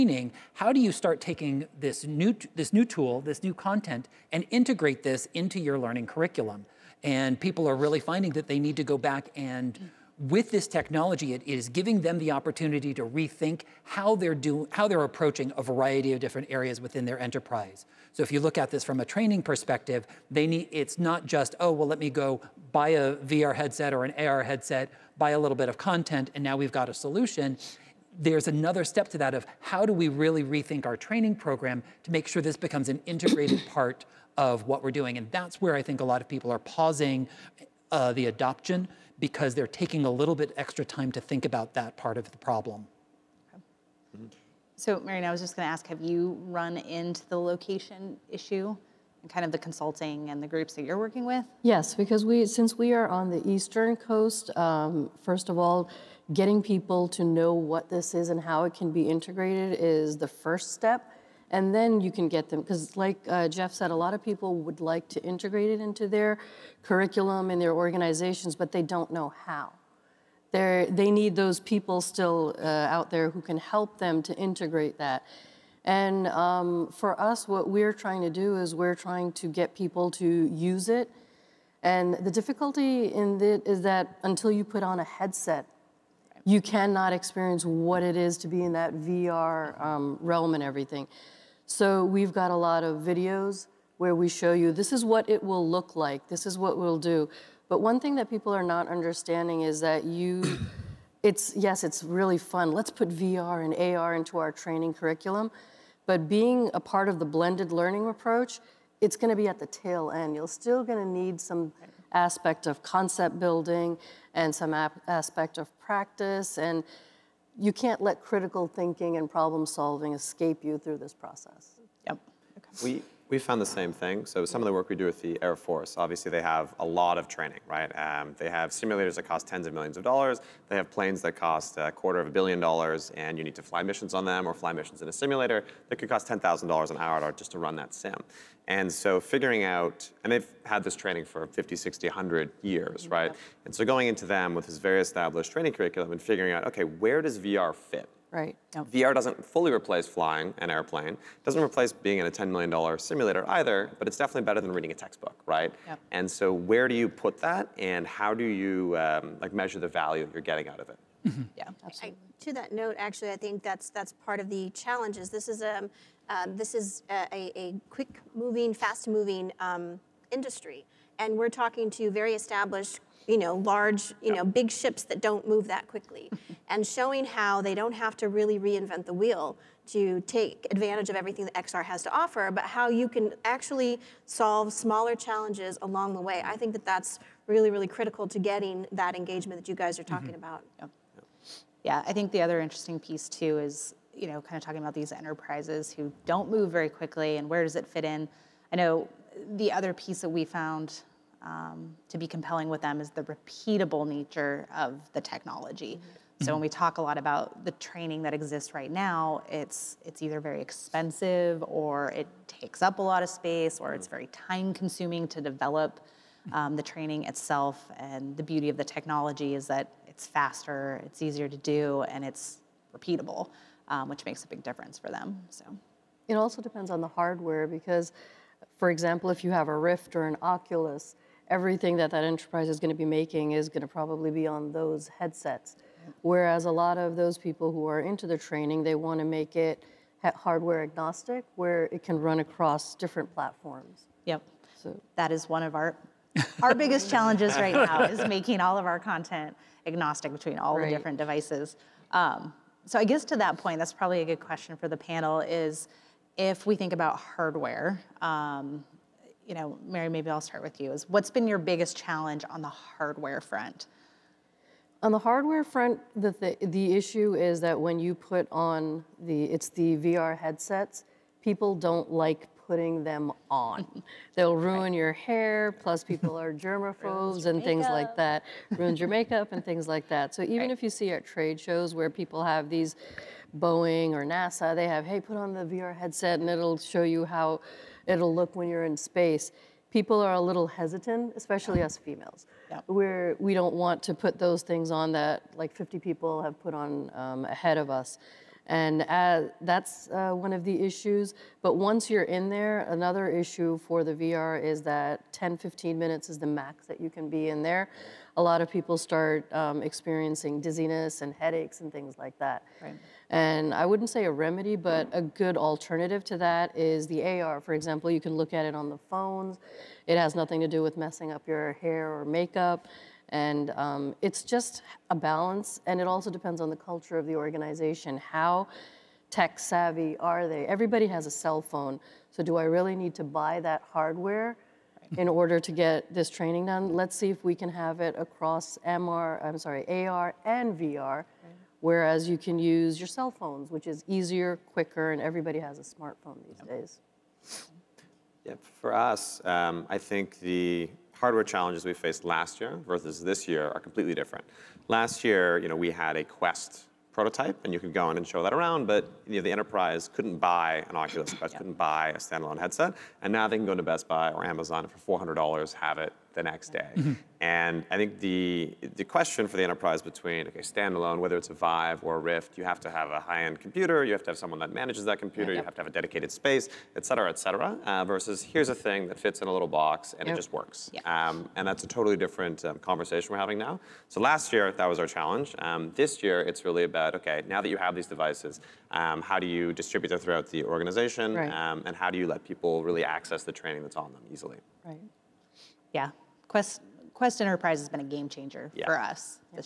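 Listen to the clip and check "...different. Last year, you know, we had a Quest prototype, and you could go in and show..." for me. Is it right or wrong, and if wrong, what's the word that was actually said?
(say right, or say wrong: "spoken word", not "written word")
right.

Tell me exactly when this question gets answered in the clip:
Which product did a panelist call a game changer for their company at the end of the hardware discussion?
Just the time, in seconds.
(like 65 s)
397 s.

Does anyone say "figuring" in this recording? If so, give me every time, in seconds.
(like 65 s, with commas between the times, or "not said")
139 s, 146 s.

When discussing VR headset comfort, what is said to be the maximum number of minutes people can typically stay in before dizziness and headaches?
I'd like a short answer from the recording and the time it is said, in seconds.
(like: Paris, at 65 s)
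15 minutes, at 305 s.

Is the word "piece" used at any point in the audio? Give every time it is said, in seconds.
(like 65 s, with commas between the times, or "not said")
193 s, 200 s.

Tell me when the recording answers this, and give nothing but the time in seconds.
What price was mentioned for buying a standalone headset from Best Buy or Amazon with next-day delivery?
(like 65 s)
365 s.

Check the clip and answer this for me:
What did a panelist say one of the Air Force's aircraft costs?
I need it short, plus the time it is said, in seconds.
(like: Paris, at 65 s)
a quarter of a billion dollars, at 131 s.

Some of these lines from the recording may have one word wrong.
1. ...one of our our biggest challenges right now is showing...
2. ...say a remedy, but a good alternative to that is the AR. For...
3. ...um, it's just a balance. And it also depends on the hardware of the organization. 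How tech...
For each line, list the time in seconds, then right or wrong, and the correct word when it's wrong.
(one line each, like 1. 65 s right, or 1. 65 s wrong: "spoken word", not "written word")
1. 245 s wrong: "making", not "showing"
2. 314 s right
3. 323 s wrong: "culture", not "hardware".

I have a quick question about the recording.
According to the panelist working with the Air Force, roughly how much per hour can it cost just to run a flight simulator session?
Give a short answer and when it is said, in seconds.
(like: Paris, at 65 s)
$10,000, at 136 s.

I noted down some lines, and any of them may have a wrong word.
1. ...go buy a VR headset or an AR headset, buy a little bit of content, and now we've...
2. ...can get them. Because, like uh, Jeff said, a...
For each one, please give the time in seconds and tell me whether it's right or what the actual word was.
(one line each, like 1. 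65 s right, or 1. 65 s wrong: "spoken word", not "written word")
1. 22 s right
2. 62 s right.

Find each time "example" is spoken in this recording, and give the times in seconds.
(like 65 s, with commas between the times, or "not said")
228 s, 317 s.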